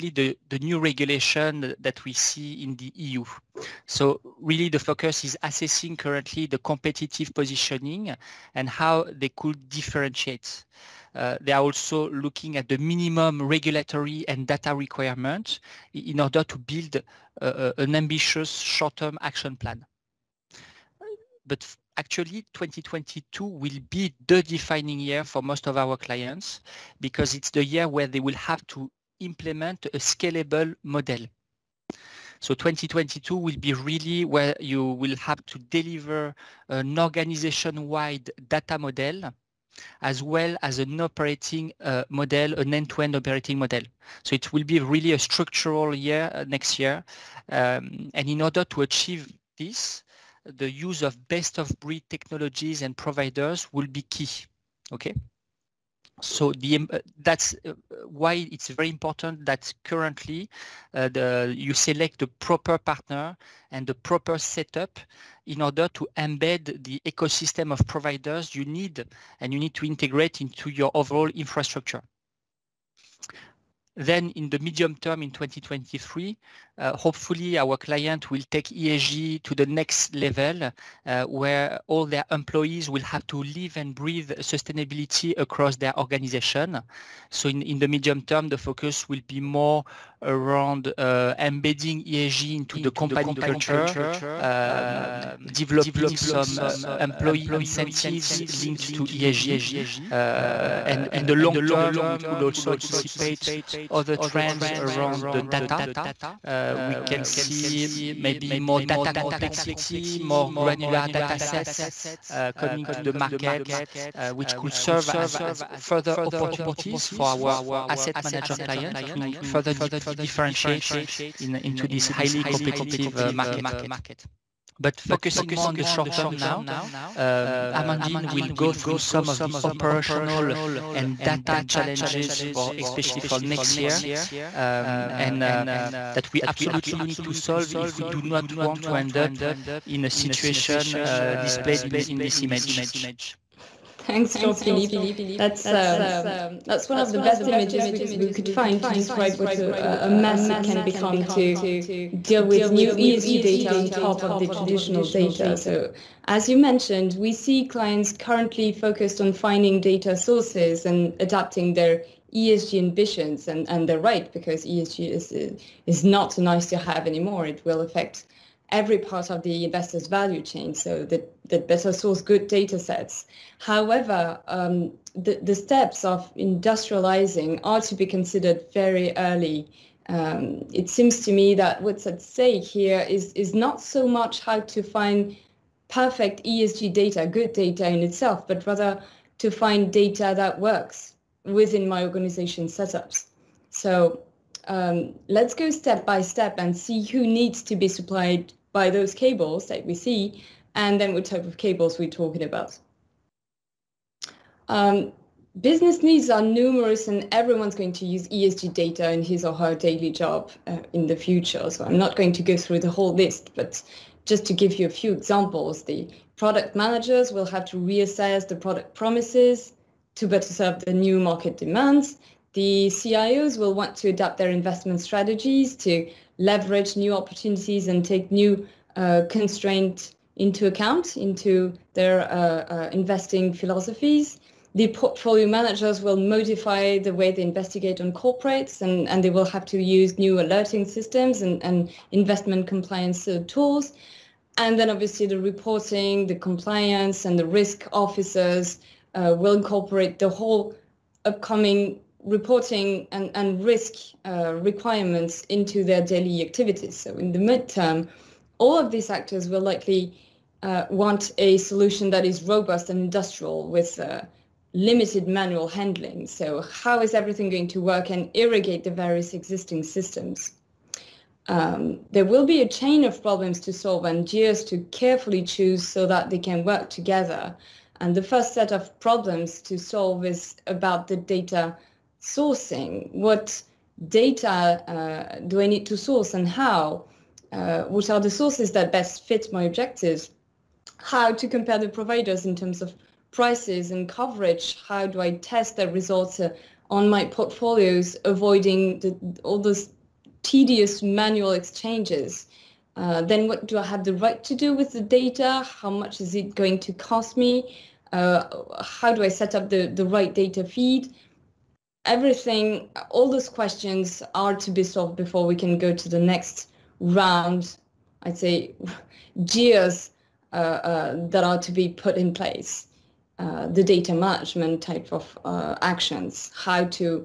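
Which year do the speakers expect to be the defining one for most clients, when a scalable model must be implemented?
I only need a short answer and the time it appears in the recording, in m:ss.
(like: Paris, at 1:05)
2022, at 0:22.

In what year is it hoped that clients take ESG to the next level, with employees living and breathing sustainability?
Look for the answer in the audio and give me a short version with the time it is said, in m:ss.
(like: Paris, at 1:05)
2023, at 1:15.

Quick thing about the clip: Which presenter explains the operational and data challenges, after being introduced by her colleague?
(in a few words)
Amandine.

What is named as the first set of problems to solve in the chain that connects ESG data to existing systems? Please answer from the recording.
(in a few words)
data sourcing.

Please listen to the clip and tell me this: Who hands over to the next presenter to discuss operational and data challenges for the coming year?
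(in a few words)
Jean-Philippe.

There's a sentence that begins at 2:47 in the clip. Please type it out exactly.
It will affect every part of the investor's value chain so that, that better source good data sets.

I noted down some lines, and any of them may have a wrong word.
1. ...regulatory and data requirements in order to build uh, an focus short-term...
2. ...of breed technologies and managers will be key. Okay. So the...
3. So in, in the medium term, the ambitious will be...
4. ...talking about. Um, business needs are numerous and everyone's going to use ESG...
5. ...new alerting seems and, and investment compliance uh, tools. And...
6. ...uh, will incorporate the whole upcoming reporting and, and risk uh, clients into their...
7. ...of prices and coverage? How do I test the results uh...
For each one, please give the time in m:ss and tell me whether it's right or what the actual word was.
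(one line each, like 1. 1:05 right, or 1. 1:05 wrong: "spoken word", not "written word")
1. 0:13 wrong: "ambitious", not "focus"
2. 0:51 wrong: "providers", not "managers"
3. 1:27 wrong: "focus", not "ambitious"
4. 3:22 right
5. 4:00 wrong: "systems", not "seems"
6. 4:09 wrong: "requirements", not "clients"
7. 4:52 right.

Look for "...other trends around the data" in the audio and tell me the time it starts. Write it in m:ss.
1:43.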